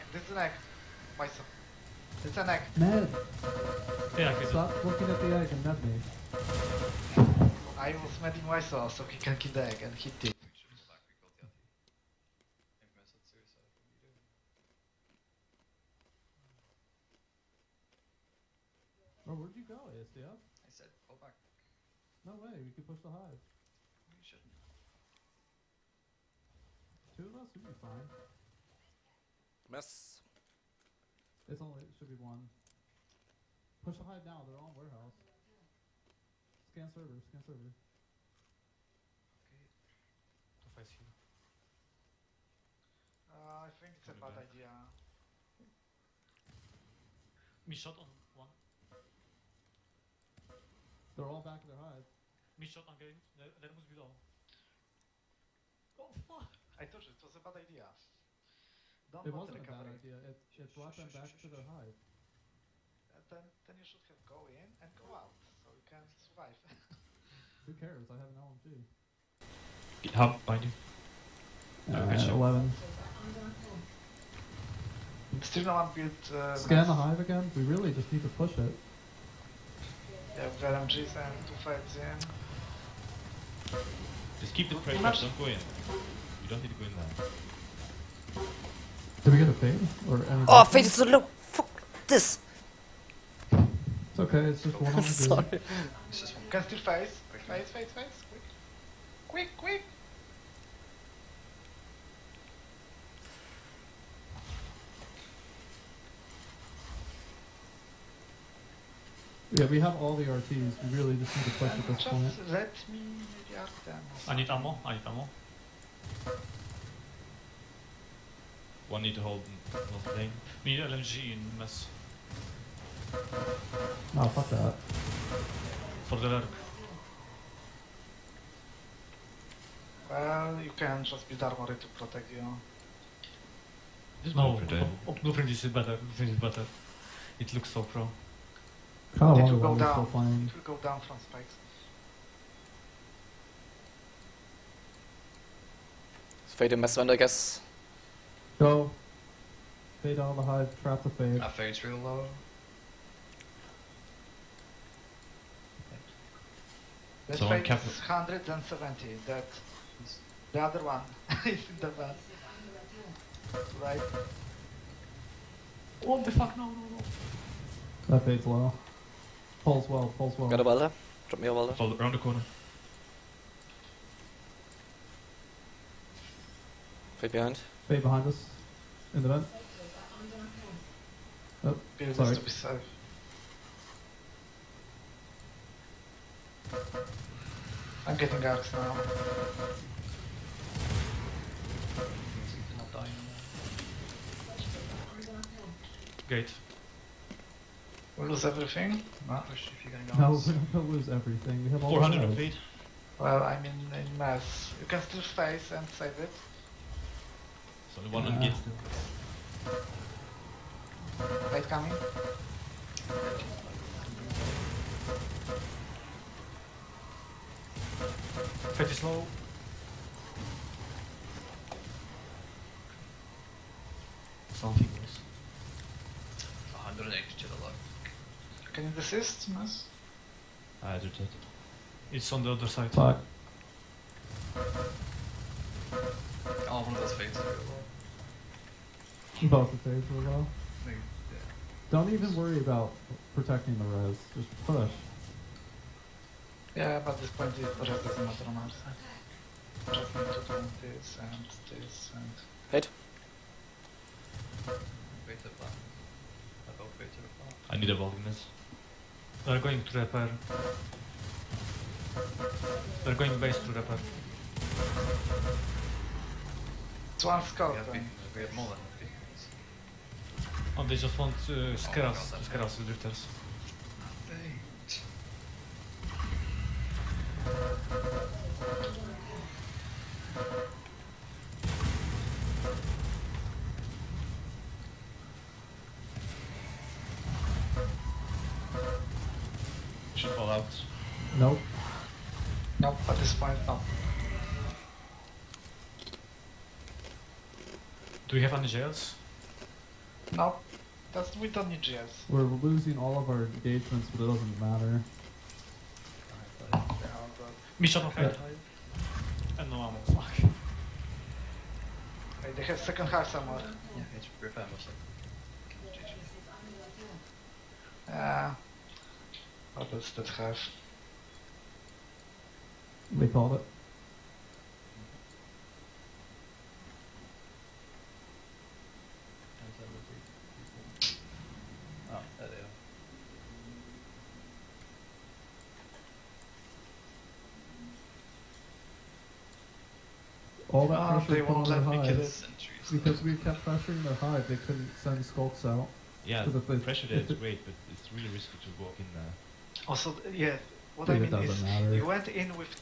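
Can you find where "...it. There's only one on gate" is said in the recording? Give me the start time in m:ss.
3:26.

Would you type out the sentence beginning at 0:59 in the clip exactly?
Don't it wasn't a bad idea.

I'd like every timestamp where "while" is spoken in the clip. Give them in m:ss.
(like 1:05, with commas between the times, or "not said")
4:00.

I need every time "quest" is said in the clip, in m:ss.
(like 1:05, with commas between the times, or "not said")
not said.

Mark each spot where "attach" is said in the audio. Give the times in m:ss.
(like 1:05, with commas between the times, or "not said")
not said.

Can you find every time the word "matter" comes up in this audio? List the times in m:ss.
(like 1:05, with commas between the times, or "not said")
4:08, 5:04, 5:51.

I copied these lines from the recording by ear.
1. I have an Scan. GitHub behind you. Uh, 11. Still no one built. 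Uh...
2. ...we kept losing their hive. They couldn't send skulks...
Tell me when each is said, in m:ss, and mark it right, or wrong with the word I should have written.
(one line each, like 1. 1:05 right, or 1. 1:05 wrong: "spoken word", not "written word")
1. 1:08 wrong: "LMG", not "Scan"
2. 5:43 wrong: "pressuring", not "losing".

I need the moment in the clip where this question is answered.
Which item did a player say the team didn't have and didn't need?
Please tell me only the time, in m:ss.
4:58.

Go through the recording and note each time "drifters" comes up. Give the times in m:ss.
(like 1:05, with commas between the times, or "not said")
4:32.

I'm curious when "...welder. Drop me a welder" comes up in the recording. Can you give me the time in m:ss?
2:50.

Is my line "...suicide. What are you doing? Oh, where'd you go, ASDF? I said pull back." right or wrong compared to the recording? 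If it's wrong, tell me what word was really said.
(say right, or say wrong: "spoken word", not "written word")
right.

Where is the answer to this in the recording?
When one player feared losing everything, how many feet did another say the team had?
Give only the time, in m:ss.
3:21.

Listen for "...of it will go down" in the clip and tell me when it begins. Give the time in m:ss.
2:19.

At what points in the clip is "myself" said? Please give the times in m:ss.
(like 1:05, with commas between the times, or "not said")
0:01, 0:08.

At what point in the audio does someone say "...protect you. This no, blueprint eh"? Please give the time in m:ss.
2:11.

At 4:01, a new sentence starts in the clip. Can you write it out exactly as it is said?
Don't even worry about protecting the res.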